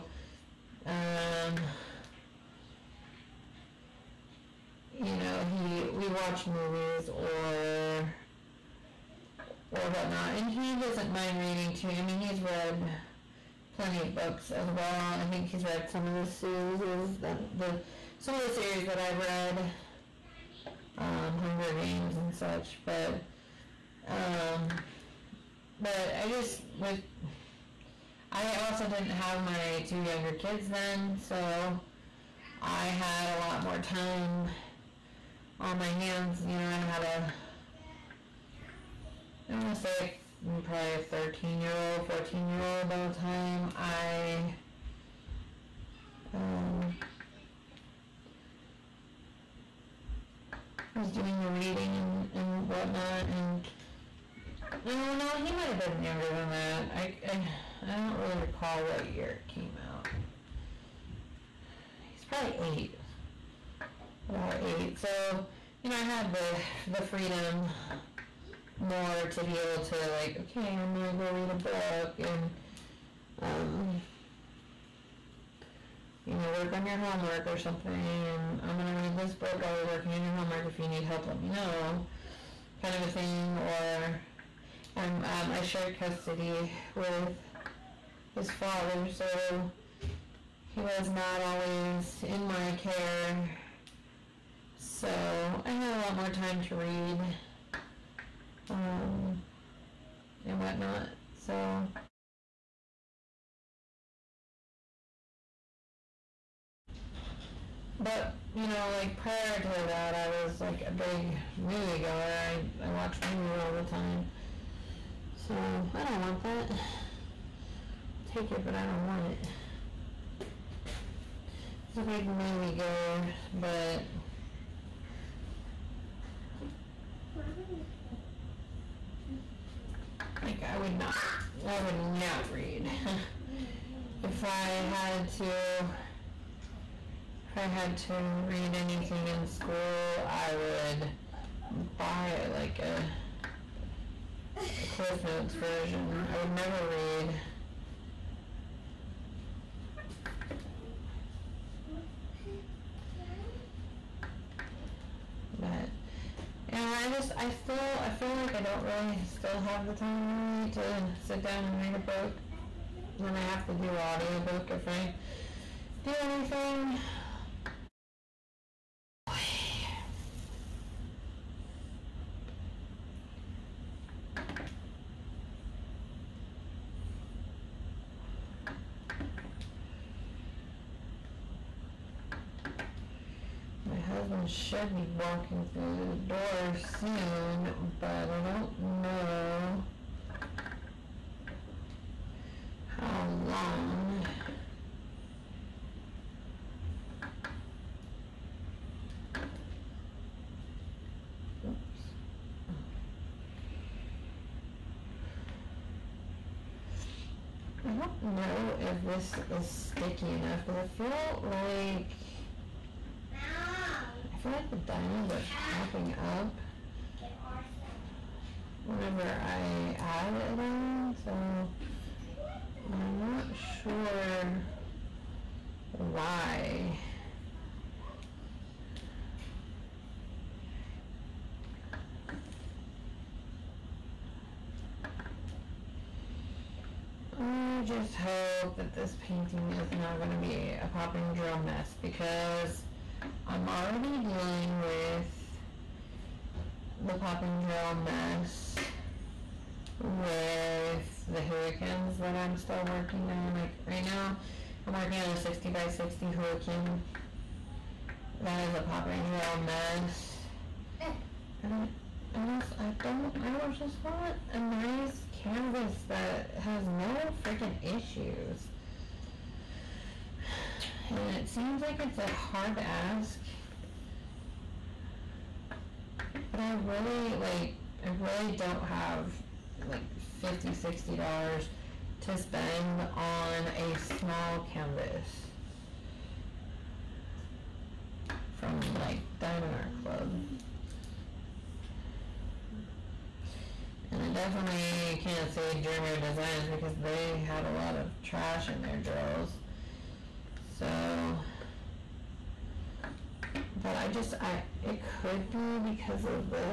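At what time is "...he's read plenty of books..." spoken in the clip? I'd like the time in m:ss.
0:12.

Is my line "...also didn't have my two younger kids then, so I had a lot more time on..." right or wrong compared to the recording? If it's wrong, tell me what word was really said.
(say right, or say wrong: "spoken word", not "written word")
right.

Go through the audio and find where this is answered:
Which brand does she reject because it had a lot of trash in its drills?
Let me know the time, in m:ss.
4:55.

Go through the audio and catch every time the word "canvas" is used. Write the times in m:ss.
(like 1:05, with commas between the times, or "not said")
4:25, 4:44.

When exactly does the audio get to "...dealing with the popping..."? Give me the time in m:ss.
4:04.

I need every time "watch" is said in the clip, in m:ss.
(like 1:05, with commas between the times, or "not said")
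0:06, 1:52.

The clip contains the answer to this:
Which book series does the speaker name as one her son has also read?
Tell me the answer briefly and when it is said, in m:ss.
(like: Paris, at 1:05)
Hunger Games, at 0:21.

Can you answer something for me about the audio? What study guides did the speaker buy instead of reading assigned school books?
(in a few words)
Cliff Notes.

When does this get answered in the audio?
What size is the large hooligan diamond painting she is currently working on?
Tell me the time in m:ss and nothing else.
4:15.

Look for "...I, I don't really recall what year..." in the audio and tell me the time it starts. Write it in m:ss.
0:57.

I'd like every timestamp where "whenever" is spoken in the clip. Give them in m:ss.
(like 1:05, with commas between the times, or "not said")
3:38.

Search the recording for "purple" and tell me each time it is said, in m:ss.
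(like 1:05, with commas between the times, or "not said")
not said.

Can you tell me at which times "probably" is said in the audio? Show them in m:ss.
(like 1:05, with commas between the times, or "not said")
0:40, 1:02.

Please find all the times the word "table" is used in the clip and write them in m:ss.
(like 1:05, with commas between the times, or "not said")
not said.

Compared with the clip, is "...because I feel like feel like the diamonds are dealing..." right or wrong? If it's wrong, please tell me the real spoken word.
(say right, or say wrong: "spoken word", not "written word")
wrong: "popping", not "dealing".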